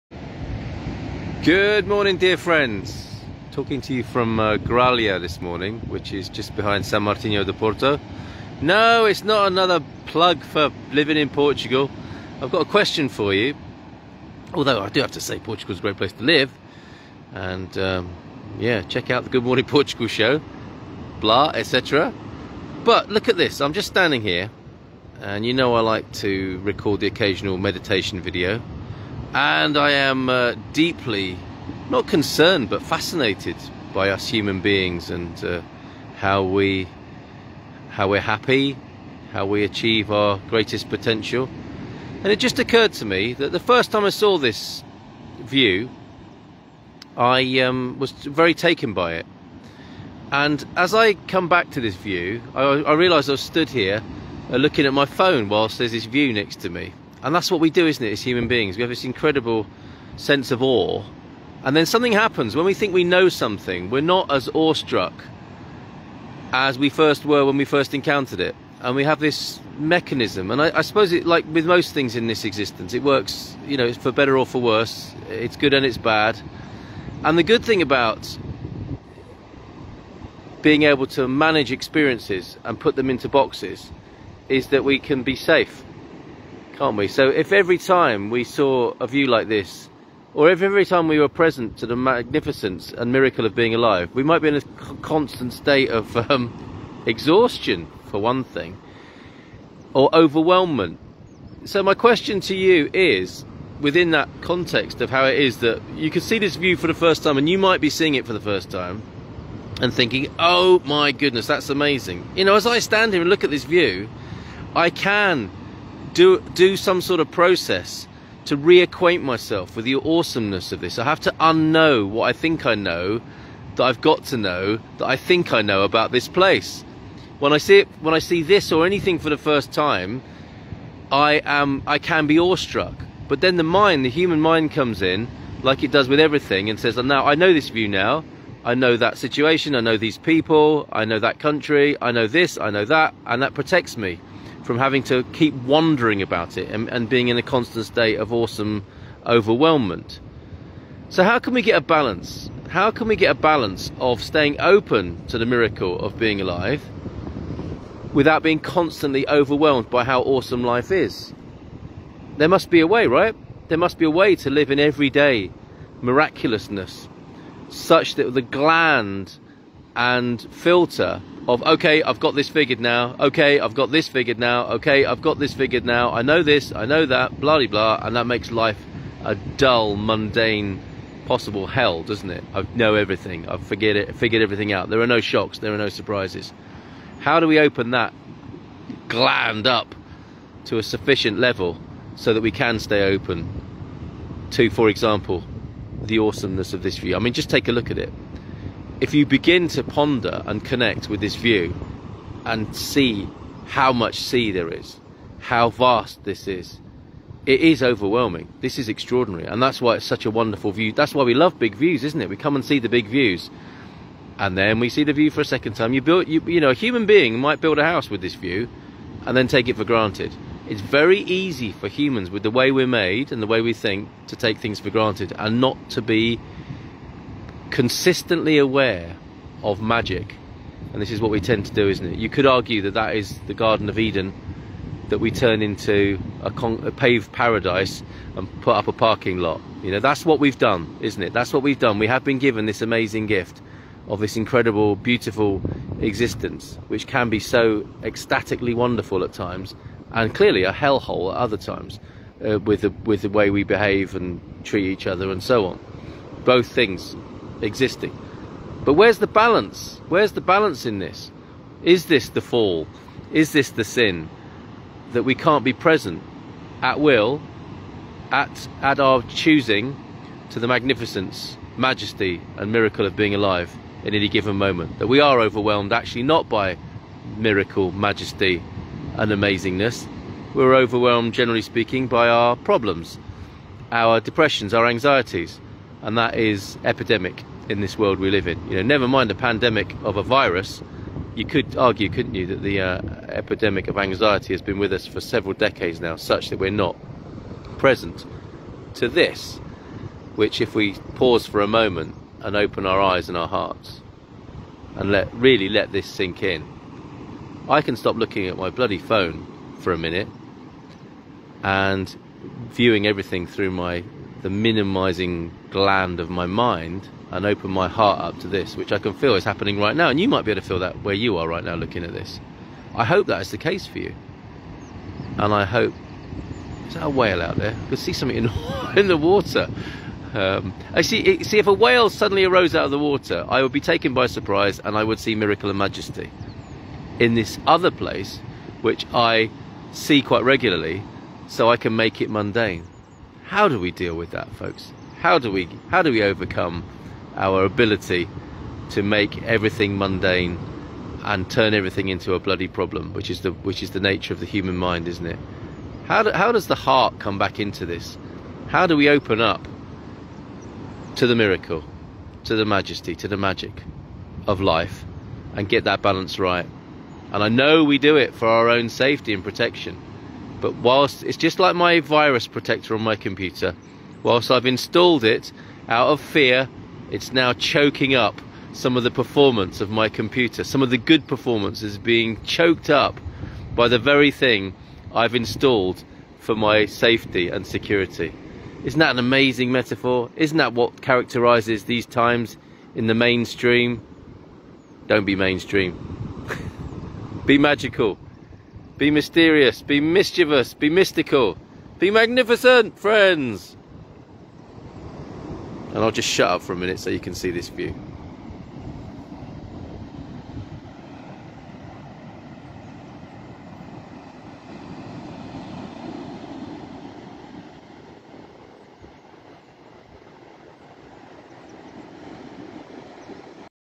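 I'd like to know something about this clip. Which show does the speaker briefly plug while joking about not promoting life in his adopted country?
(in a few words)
Good Morning Portugal.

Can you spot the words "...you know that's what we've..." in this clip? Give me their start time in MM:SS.
03:59.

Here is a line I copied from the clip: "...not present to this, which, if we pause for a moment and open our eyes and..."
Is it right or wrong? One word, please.
right.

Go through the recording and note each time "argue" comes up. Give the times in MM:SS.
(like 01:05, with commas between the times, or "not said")
03:52, 04:51.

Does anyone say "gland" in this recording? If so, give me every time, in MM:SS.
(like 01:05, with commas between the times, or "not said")
02:48, 03:09, 05:15.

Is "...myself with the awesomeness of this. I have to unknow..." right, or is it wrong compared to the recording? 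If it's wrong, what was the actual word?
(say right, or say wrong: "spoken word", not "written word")
right.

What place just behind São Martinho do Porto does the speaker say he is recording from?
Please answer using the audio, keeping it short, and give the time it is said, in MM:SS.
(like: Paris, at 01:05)
Gralha, at 00:04.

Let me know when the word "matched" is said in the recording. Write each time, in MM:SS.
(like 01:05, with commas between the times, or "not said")
not said.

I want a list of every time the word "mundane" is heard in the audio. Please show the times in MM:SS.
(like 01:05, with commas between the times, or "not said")
02:59, 05:42, 05:49.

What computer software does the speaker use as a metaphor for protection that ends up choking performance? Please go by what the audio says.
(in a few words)
Virus protector.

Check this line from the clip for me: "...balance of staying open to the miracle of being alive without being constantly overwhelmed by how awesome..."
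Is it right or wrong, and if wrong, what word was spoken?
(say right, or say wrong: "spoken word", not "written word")
right.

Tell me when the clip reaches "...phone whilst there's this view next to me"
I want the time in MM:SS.
00:55.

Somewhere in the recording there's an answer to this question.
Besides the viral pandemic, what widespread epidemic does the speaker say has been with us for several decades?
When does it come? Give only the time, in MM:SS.
04:53.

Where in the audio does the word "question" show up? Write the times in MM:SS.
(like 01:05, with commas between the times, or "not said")
00:12, 01:41.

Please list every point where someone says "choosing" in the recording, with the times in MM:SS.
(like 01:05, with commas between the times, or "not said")
04:29.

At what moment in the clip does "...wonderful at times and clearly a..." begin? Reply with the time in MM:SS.
04:08.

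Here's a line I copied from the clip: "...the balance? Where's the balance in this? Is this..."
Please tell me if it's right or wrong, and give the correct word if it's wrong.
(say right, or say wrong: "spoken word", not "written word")
right.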